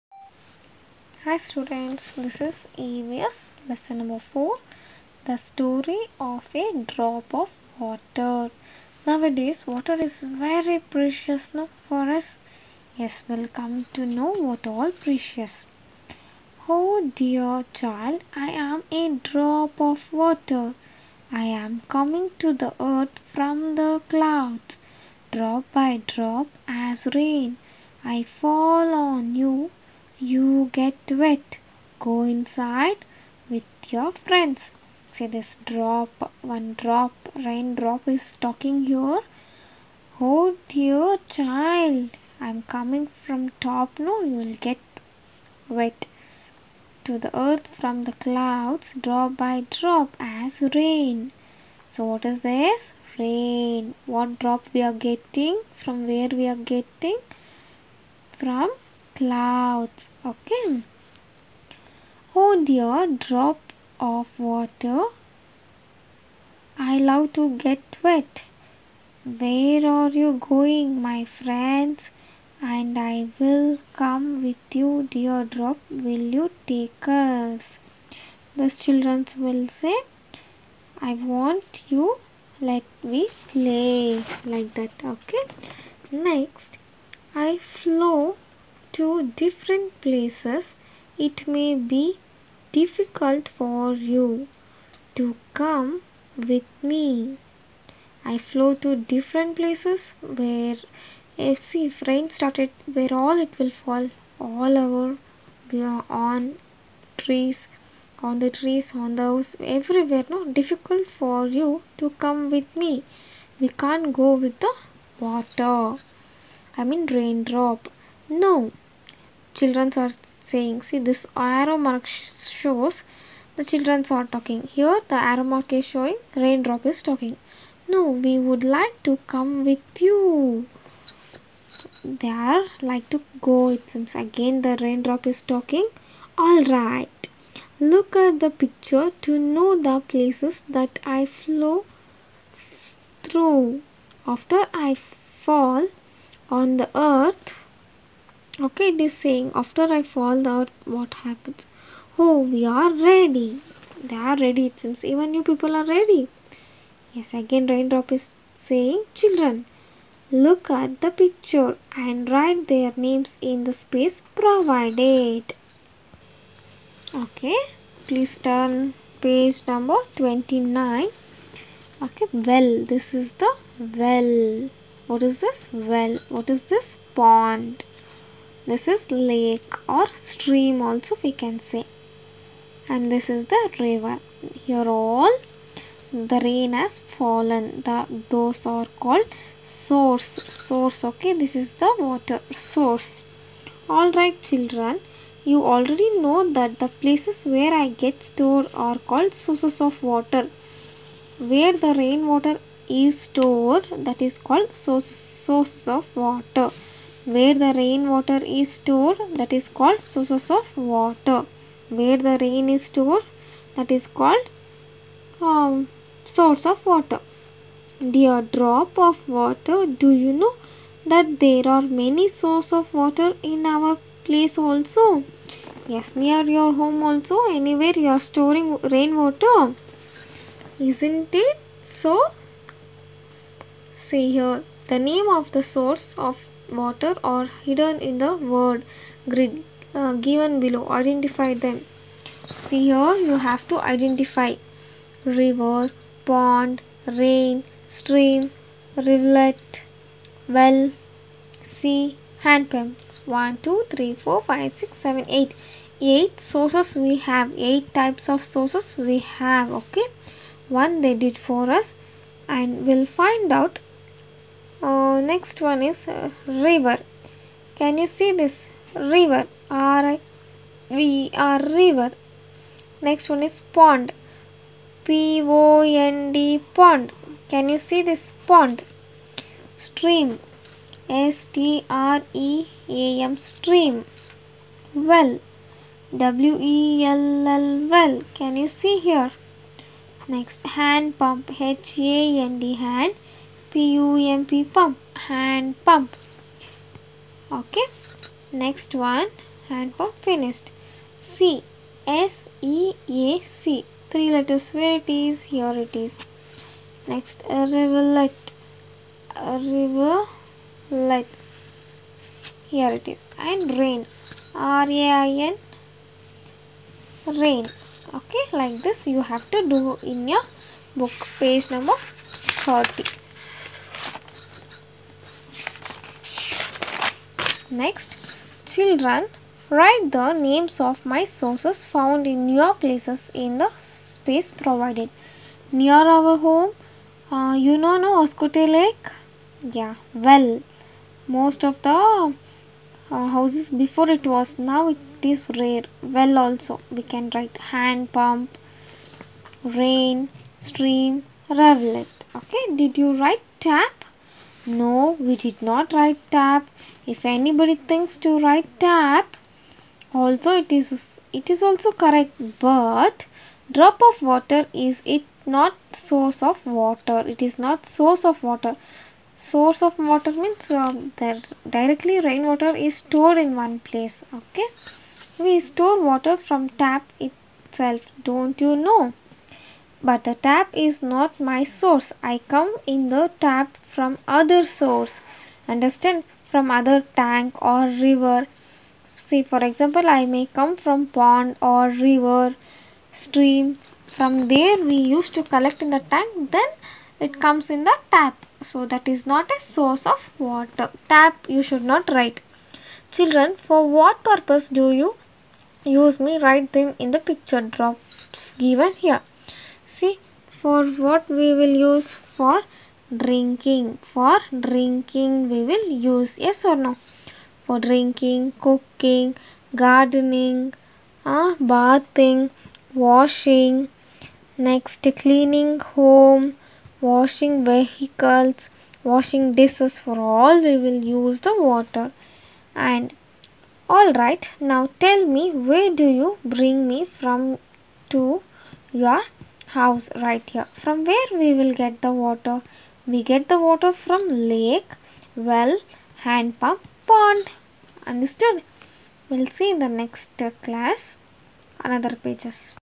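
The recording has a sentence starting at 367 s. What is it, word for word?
It is not source of water.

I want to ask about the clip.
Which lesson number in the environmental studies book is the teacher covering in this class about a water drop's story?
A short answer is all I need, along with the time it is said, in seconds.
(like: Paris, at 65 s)
4, at 3 s.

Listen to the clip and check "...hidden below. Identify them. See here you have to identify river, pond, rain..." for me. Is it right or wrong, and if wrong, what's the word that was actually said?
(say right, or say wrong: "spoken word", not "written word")
wrong: "given", not "hidden".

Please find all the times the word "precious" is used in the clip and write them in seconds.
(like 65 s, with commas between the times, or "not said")
10 s, 14 s.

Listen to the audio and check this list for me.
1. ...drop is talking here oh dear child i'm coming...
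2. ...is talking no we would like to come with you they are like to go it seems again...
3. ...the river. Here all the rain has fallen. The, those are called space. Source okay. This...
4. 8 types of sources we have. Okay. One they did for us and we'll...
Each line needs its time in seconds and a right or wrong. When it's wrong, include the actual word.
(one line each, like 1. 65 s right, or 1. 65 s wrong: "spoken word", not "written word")
1. 37 s right
2. 126 s right
3. 183 s wrong: "source", not "space"
4. 257 s right.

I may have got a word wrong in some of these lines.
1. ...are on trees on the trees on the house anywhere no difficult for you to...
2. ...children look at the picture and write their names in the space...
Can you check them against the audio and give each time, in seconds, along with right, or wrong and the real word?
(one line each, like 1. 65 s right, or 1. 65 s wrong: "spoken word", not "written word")
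1. 105 s wrong: "everywhere", not "anywhere"
2. 159 s right.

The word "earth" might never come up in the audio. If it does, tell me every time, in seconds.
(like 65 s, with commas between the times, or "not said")
22 s, 47 s, 147 s.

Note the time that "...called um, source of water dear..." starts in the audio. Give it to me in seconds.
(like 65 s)
214 s.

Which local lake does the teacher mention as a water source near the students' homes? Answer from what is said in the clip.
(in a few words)
Hoskote Lake.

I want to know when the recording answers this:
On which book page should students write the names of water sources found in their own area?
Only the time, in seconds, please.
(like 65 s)
321 s.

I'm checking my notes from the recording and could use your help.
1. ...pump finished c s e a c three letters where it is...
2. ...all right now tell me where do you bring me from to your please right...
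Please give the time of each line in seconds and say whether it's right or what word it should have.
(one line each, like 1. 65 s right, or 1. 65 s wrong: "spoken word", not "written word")
1. 299 s right
2. 433 s wrong: "house", not "please".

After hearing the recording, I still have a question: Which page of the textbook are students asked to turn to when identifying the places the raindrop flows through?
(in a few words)
29.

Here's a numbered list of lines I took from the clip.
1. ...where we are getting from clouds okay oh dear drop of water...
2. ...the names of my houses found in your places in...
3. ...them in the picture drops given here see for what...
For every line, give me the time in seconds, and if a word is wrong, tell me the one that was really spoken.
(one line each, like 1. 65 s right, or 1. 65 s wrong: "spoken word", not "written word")
1. 56 s right
2. 330 s wrong: "sources", not "houses"
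3. 406 s right.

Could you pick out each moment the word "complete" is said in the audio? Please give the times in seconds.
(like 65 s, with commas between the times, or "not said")
not said.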